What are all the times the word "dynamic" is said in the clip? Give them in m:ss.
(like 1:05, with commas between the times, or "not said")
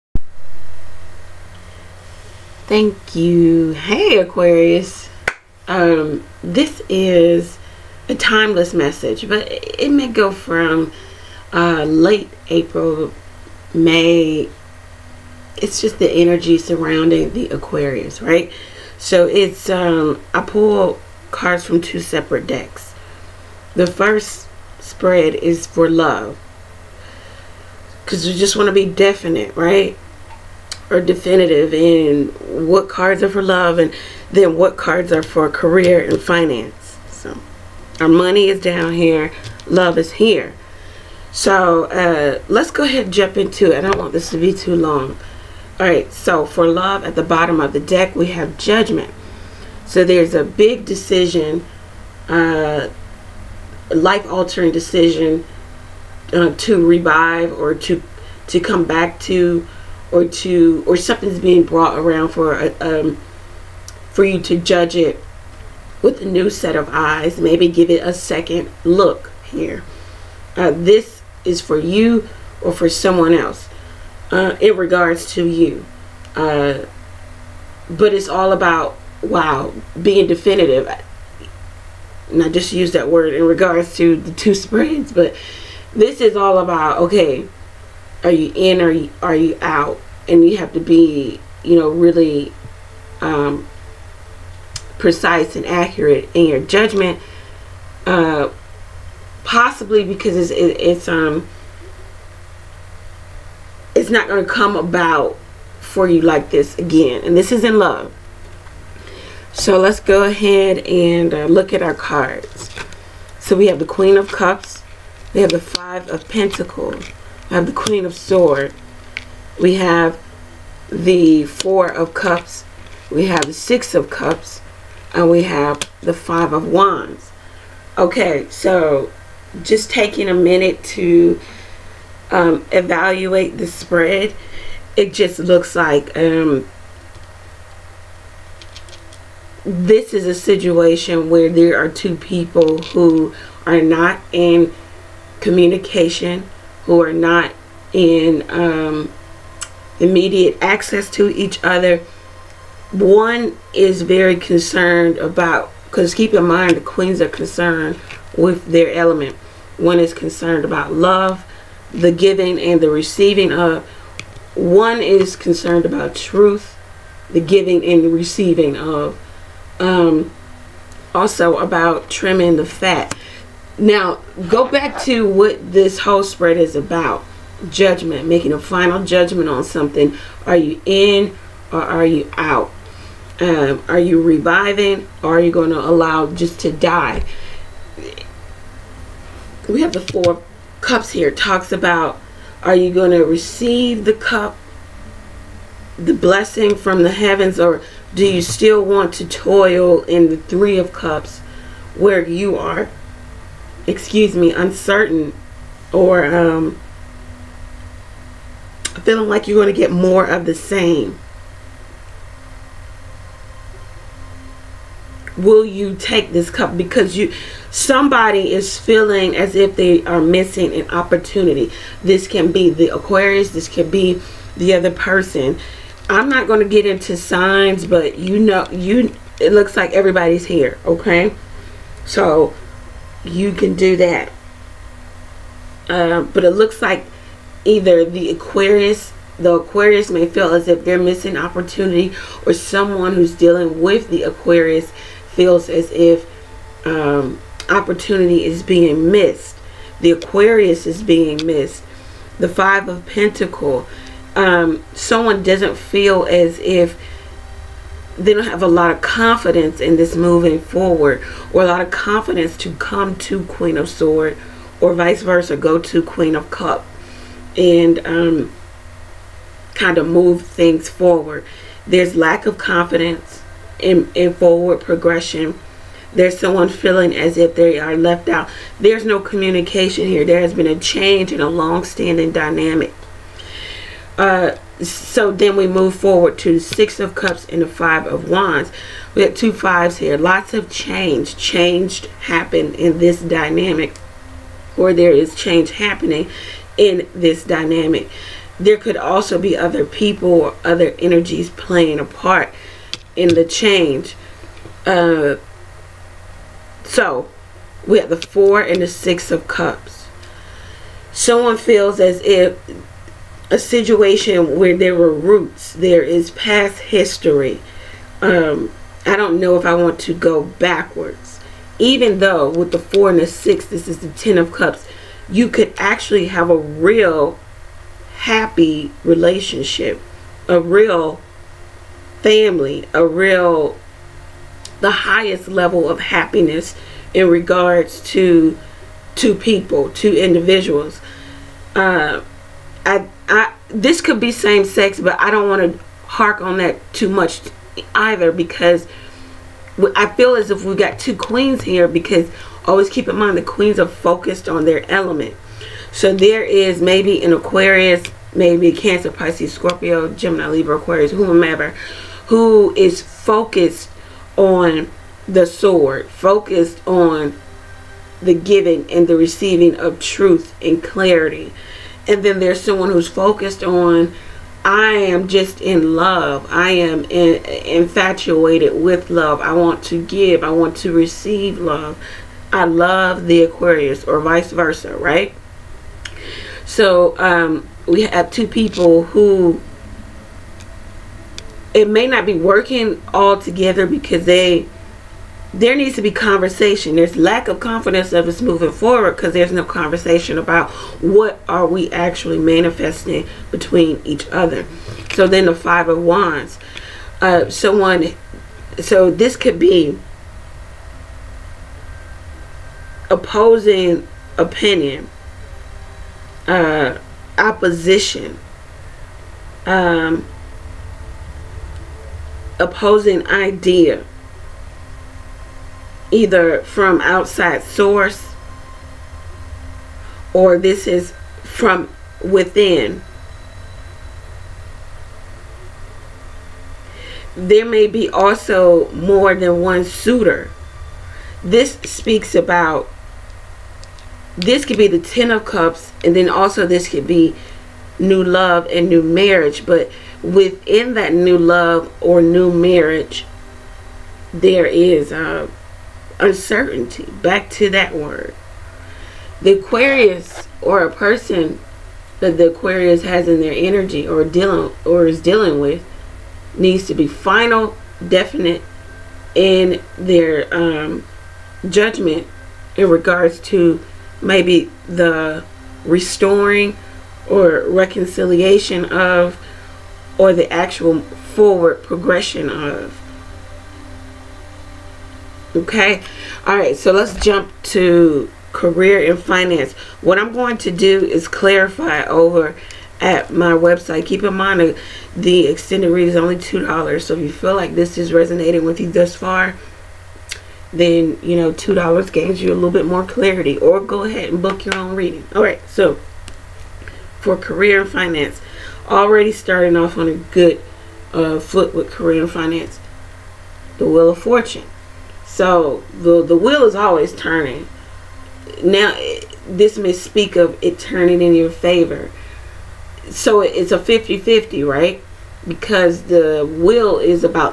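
4:42, 4:53, 4:57.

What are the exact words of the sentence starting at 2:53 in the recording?
Now, go back to what this whole spread is about judgment, making a final judgment on something.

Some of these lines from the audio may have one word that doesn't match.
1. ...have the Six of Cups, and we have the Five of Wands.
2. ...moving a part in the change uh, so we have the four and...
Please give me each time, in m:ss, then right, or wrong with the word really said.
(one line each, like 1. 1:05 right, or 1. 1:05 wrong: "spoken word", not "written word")
1. 2:03 right
2. 5:01 wrong: "playing", not "moving".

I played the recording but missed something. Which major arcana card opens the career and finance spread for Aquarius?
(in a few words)
Wheel of Fortune.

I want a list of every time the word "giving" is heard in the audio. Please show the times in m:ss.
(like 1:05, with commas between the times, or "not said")
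2:42, 2:47, 6:08.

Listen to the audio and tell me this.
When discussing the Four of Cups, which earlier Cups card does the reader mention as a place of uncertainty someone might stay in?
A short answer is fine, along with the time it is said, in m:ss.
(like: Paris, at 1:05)
Three of Cups, at 3:20.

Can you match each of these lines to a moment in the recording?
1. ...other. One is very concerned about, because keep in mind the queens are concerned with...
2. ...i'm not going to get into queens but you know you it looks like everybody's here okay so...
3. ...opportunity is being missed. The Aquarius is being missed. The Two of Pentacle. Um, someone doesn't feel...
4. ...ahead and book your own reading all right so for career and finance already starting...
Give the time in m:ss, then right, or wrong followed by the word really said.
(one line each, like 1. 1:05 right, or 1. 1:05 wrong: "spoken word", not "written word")
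1. 2:31 right
2. 3:46 wrong: "signs", not "queens"
3. 4:07 wrong: "Five", not "Two"
4. 8:24 right.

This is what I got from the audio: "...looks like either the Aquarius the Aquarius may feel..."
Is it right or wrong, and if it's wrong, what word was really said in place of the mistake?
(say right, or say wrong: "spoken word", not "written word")
right.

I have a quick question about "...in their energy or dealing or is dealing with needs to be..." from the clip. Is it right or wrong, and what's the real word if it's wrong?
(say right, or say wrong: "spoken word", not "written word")
right.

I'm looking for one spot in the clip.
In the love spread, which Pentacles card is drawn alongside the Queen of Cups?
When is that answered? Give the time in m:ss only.
1:55.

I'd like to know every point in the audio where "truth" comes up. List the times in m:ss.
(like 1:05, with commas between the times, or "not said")
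2:46, 6:10.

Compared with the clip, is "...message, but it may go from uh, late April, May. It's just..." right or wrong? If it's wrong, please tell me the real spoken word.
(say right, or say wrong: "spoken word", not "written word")
right.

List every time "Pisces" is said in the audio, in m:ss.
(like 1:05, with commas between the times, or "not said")
5:59.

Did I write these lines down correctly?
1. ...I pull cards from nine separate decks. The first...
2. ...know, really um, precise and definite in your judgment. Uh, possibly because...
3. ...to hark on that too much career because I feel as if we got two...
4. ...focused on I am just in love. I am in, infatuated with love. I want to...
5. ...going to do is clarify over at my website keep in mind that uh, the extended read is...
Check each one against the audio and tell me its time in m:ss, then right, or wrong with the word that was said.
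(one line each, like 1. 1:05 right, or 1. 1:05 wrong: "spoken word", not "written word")
1. 0:20 wrong: "two", not "nine"
2. 1:31 wrong: "accurate", not "definite"
3. 5:45 wrong: "either", not "career"
4. 6:13 right
5. 8:10 right.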